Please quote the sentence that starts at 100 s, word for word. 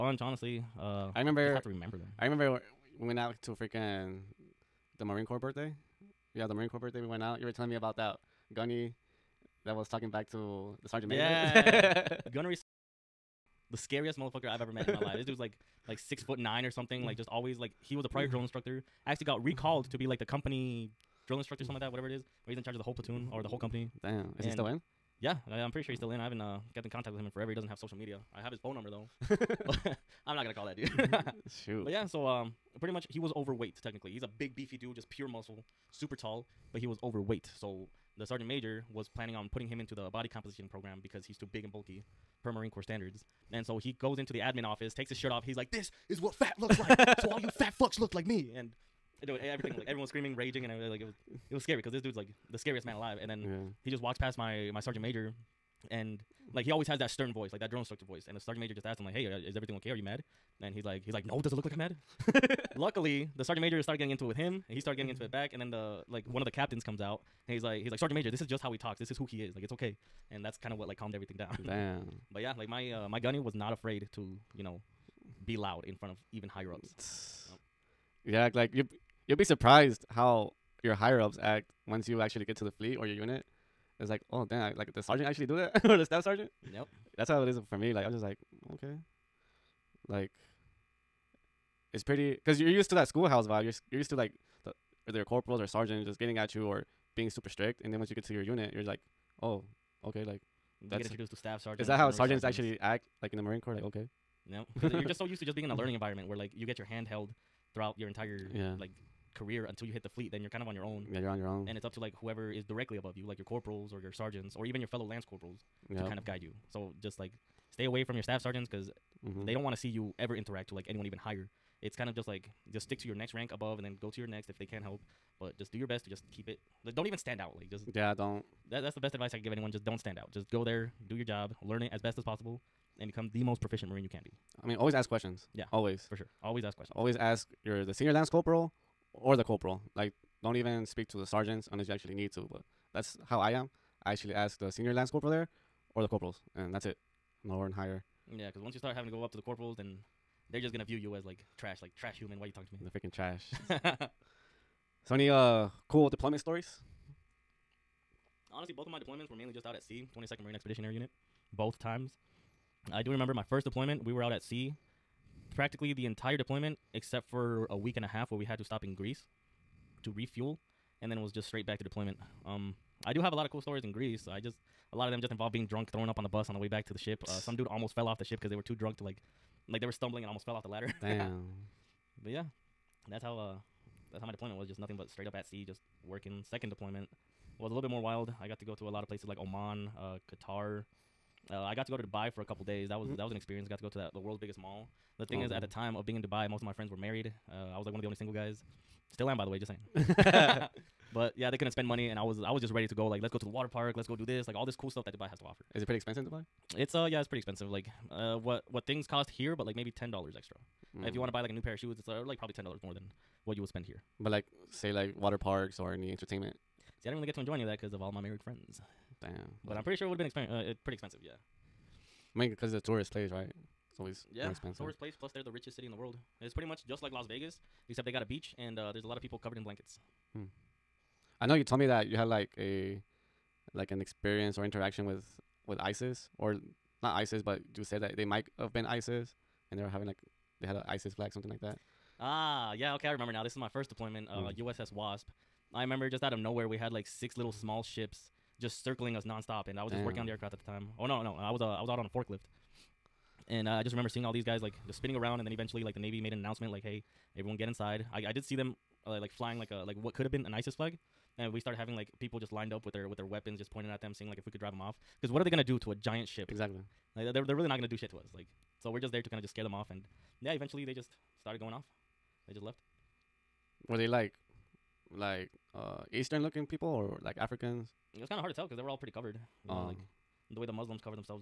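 You get introduced to staff sergeants.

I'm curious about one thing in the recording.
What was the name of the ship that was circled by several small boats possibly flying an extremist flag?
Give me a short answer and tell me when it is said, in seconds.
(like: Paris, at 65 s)
USS Wasp, at 244 s.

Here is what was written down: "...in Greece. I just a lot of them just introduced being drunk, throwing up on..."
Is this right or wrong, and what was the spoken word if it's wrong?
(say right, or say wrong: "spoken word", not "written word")
wrong: "involved", not "introduced".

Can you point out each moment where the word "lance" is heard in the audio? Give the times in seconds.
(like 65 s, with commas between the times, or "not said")
115 s, 138 s, 144 s.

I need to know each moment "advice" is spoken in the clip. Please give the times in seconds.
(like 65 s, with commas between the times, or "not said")
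129 s.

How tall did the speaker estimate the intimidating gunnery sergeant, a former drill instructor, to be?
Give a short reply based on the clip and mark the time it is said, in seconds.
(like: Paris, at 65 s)
6 foot 9, at 15 s.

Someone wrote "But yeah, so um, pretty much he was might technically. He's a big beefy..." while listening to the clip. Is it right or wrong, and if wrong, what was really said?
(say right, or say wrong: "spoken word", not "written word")
wrong: "overweight", not "might".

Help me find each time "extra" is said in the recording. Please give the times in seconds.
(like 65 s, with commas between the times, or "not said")
210 s.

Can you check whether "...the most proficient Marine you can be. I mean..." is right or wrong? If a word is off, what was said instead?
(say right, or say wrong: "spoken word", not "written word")
right.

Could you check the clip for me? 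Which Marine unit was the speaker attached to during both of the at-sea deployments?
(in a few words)
22nd Marine Expeditionary Unit.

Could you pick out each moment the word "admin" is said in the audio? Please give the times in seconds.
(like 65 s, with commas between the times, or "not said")
44 s.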